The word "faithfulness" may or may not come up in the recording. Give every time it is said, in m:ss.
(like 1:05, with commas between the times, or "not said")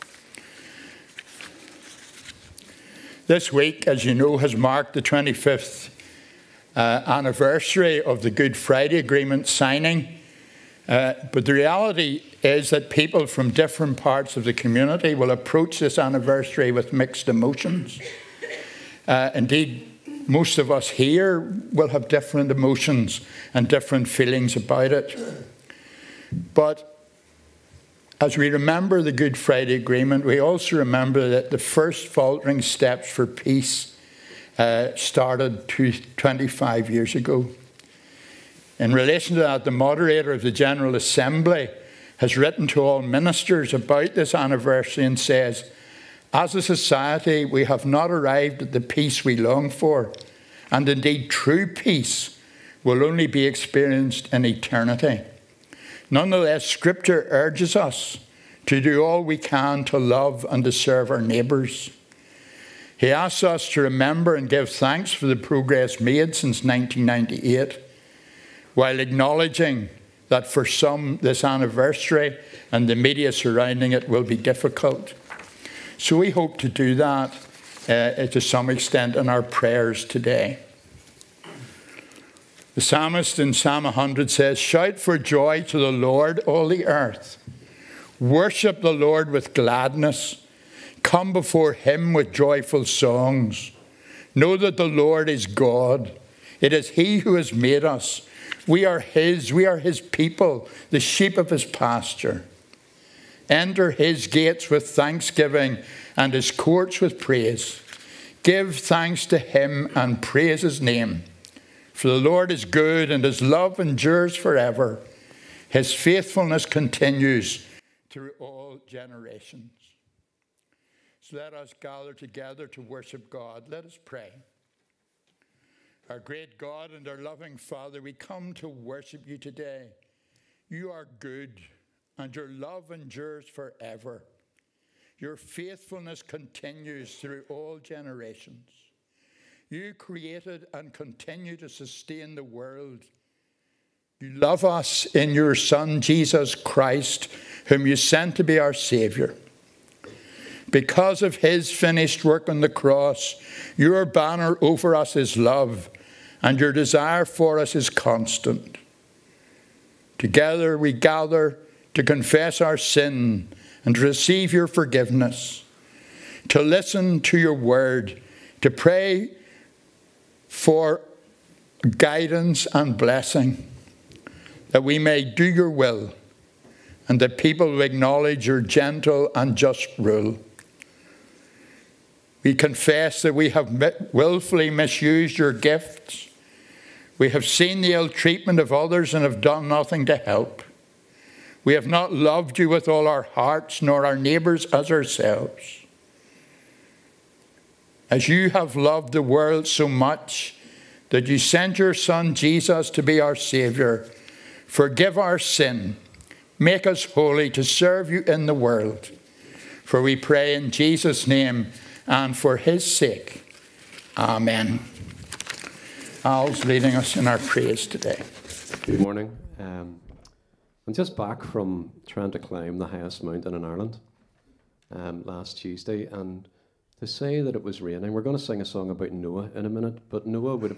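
1:55, 2:15.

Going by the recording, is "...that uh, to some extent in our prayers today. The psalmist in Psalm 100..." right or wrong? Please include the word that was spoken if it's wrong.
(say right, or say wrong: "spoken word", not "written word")
right.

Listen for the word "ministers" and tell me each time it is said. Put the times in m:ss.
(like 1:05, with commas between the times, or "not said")
0:43.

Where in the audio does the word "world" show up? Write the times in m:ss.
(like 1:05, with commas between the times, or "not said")
2:22, 3:19, 3:28.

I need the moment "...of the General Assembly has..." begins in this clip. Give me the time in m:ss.
0:40.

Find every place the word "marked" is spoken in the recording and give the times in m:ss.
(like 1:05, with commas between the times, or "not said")
0:04.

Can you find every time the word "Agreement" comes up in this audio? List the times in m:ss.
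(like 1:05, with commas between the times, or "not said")
0:08, 0:29.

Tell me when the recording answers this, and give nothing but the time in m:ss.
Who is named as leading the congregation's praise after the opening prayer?
3:36.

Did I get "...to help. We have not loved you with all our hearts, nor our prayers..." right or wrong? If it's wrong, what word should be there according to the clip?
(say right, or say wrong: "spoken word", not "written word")
wrong: "neighbours", not "prayers".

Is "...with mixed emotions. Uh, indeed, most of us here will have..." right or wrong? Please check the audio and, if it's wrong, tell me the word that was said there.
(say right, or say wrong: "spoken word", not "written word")
right.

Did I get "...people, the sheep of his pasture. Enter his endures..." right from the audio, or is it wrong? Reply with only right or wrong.
wrong.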